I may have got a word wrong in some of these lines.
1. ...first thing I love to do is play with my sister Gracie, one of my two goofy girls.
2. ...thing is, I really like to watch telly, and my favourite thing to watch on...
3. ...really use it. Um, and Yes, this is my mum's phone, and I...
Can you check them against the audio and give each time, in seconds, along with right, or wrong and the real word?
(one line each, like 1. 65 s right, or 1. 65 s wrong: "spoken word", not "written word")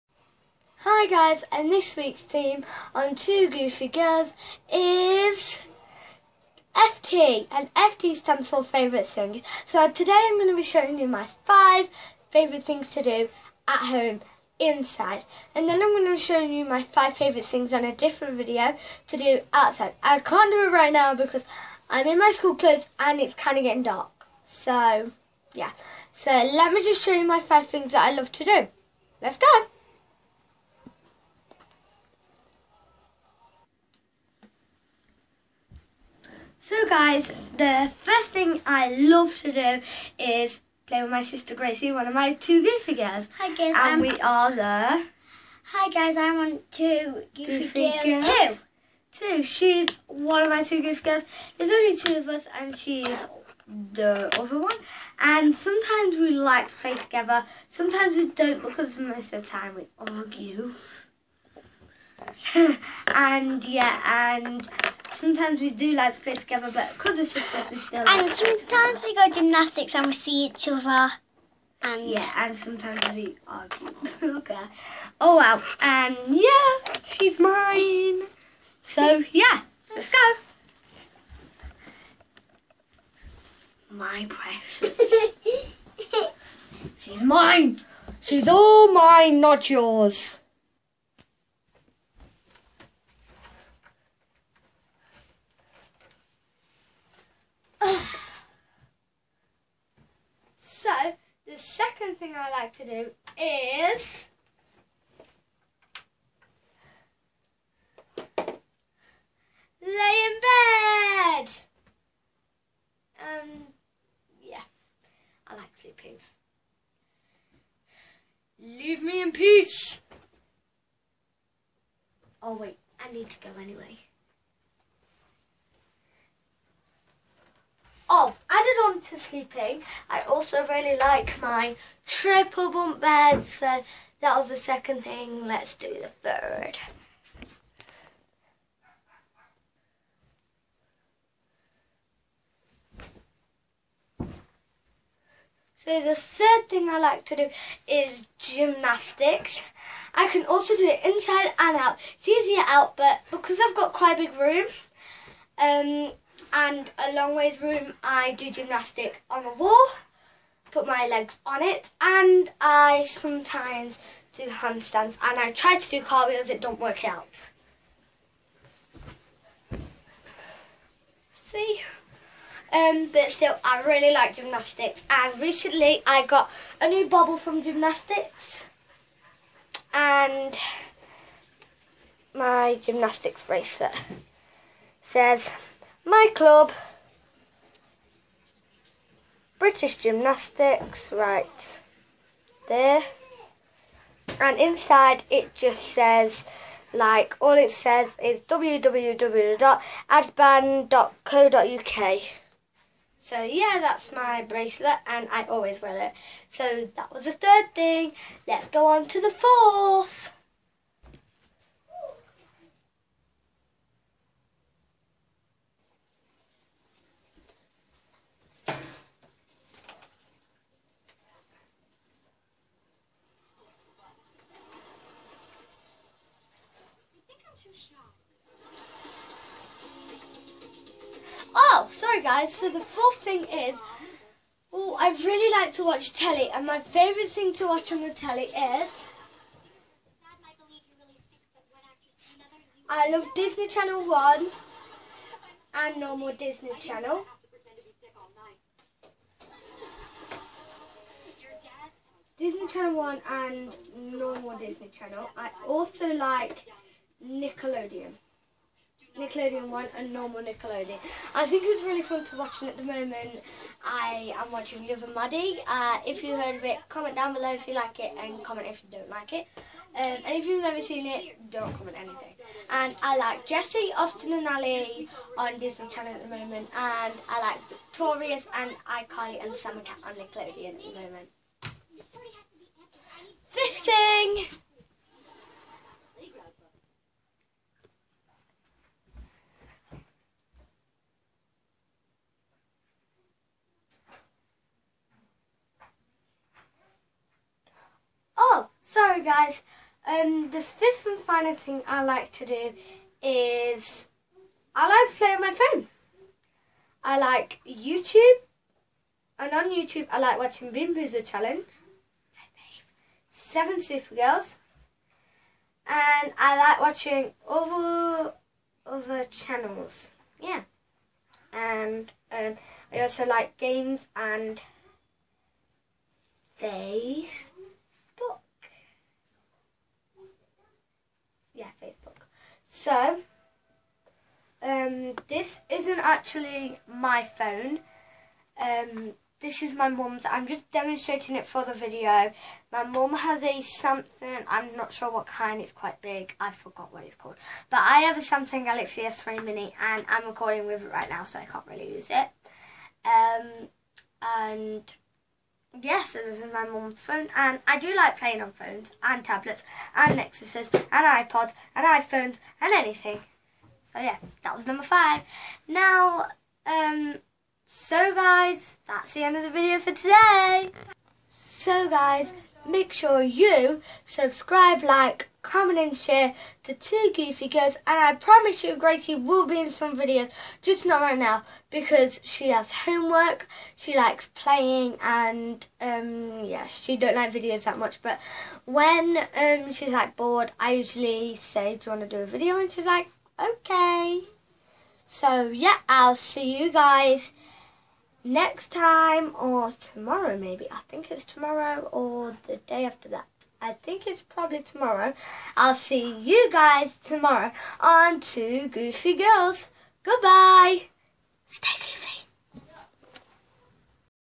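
1. 38 s right
2. 233 s right
3. 351 s right.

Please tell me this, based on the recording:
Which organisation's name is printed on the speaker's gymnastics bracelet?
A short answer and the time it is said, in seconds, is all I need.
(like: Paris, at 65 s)
British Gymnastics, at 189 s.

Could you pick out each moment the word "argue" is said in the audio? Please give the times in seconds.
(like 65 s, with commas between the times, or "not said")
59 s, 73 s.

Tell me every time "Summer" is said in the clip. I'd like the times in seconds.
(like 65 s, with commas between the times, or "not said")
279 s.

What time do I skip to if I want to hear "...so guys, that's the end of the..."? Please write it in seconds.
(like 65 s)
367 s.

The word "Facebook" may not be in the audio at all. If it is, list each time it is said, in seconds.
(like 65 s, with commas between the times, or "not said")
331 s.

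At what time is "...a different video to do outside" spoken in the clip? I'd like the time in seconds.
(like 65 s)
17 s.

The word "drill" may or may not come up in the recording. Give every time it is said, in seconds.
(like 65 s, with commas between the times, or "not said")
not said.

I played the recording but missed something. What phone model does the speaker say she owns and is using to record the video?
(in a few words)
Samsung Galaxy S3 Mini.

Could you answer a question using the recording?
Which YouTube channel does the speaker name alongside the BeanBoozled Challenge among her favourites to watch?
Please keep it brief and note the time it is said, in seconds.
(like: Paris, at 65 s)
Seven Supergirls, at 313 s.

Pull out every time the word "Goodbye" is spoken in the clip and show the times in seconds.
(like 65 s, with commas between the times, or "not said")
410 s.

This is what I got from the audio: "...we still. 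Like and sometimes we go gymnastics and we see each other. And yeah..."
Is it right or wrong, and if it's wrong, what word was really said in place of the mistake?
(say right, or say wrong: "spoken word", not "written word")
right.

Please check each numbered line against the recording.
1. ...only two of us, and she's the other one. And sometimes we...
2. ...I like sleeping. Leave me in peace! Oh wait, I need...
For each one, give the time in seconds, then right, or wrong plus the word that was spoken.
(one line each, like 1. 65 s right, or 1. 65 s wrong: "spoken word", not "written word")
1. 51 s right
2. 115 s right.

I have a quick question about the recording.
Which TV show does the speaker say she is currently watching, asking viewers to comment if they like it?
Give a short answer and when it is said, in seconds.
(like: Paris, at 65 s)
Liv and Maddie, at 264 s.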